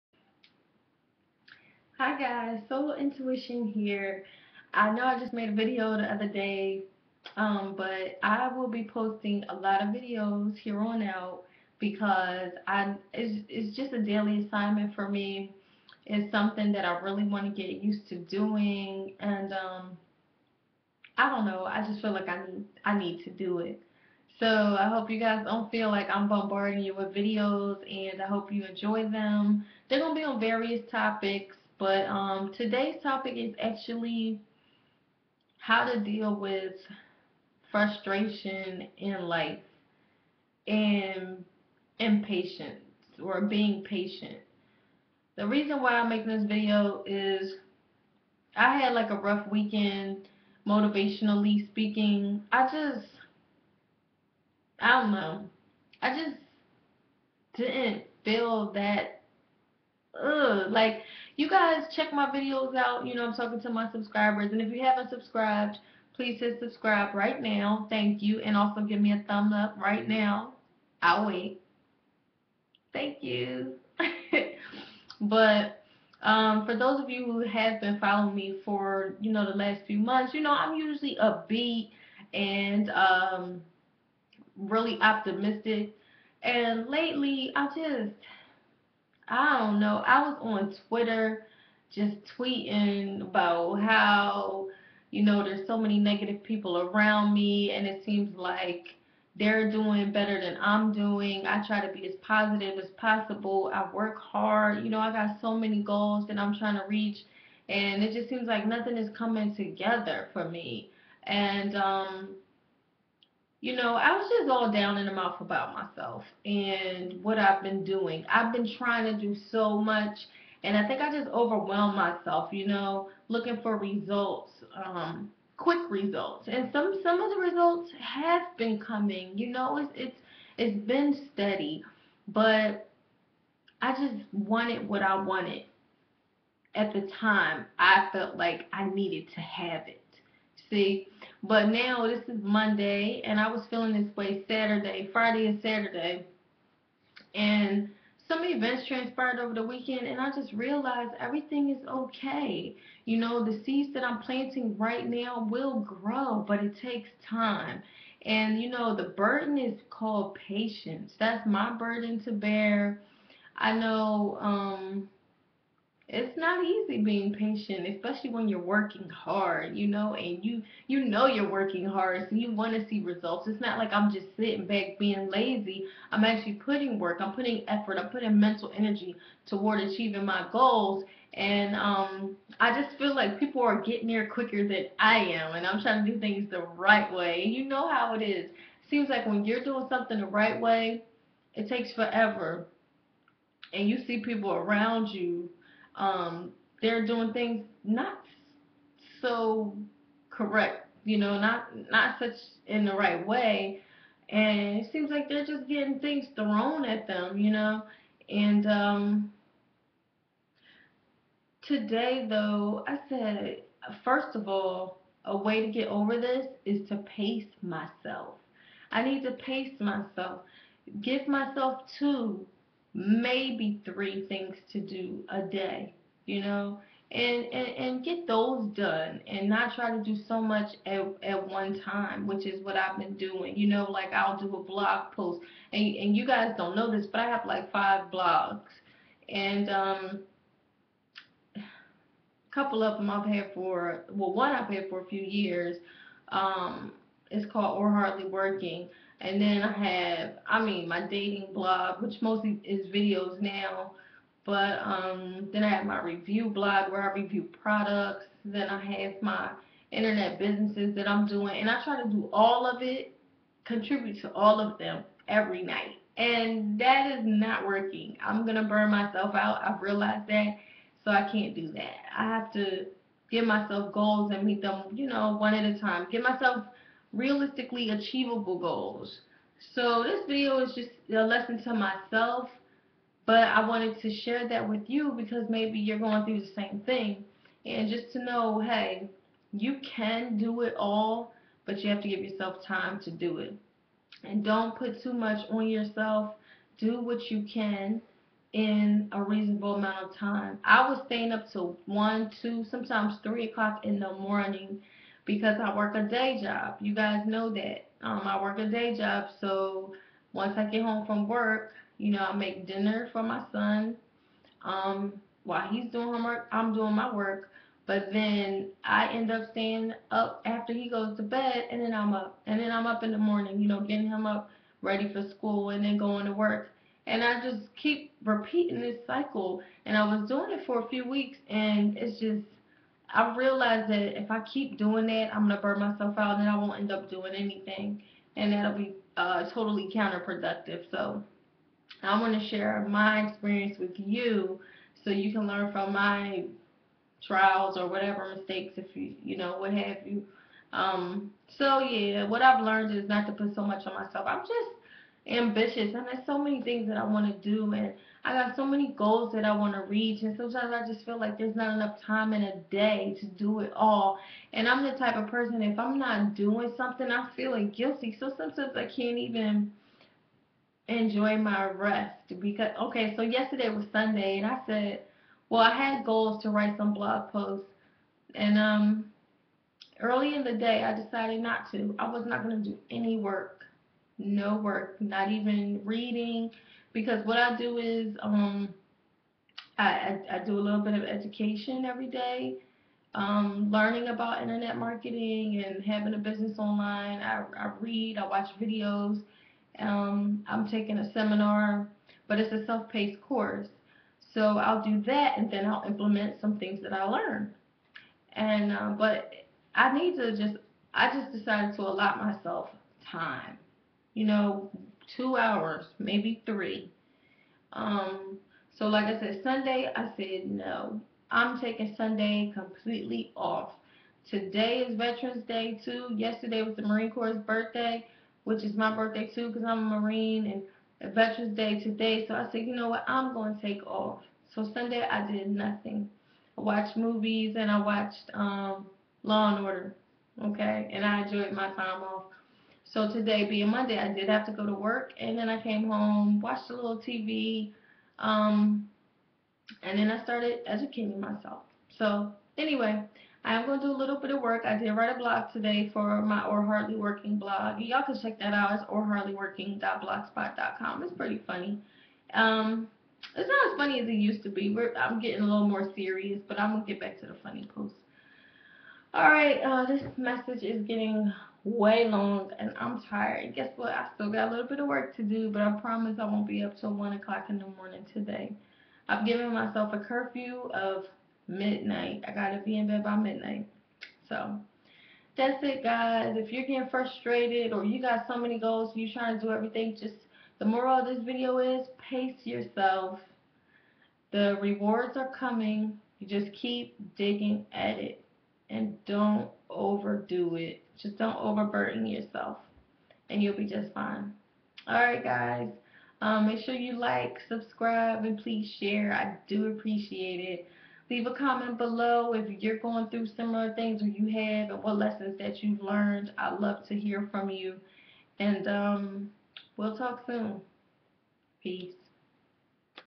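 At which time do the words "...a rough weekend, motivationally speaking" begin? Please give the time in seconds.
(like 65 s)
49 s.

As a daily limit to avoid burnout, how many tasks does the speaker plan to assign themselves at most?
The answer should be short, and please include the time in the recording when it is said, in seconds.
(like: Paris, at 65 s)
3, at 221 s.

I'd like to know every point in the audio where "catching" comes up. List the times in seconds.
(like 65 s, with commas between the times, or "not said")
not said.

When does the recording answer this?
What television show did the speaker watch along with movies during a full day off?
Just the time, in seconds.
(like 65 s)
439 s.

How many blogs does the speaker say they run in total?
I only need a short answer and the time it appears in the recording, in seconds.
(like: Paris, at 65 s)
5, at 237 s.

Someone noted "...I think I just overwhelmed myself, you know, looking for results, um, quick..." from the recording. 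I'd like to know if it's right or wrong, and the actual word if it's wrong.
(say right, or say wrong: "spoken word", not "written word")
right.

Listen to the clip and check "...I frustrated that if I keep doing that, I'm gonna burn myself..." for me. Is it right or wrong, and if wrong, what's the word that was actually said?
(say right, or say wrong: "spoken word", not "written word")
wrong: "realized", not "frustrated".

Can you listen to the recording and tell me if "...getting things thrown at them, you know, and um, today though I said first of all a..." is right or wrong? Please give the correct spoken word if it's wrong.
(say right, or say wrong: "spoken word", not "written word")
right.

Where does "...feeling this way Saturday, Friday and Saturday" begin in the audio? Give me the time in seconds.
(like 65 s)
143 s.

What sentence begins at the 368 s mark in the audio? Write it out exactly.
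So sometimes I can't even enjoy my rest because okay.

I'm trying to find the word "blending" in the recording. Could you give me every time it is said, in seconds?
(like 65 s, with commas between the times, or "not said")
not said.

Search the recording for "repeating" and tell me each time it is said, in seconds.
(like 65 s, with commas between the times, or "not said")
328 s.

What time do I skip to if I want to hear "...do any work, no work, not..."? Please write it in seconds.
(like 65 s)
382 s.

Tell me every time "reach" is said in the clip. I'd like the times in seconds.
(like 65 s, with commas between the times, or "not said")
106 s, 359 s.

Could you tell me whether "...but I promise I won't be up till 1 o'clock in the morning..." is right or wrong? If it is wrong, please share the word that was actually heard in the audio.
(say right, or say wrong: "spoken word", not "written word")
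right.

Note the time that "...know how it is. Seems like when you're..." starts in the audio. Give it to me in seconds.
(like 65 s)
187 s.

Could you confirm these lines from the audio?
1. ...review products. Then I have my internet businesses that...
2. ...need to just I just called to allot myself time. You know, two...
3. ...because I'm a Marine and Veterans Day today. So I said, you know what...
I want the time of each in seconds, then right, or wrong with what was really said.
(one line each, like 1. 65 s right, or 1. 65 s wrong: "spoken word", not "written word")
1. 257 s right
2. 409 s wrong: "decided", not "called"
3. 429 s right.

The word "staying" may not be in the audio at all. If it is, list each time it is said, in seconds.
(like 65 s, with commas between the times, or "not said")
301 s, 319 s.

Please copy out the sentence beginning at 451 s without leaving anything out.
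So anyway, I am going to do a little bit of work.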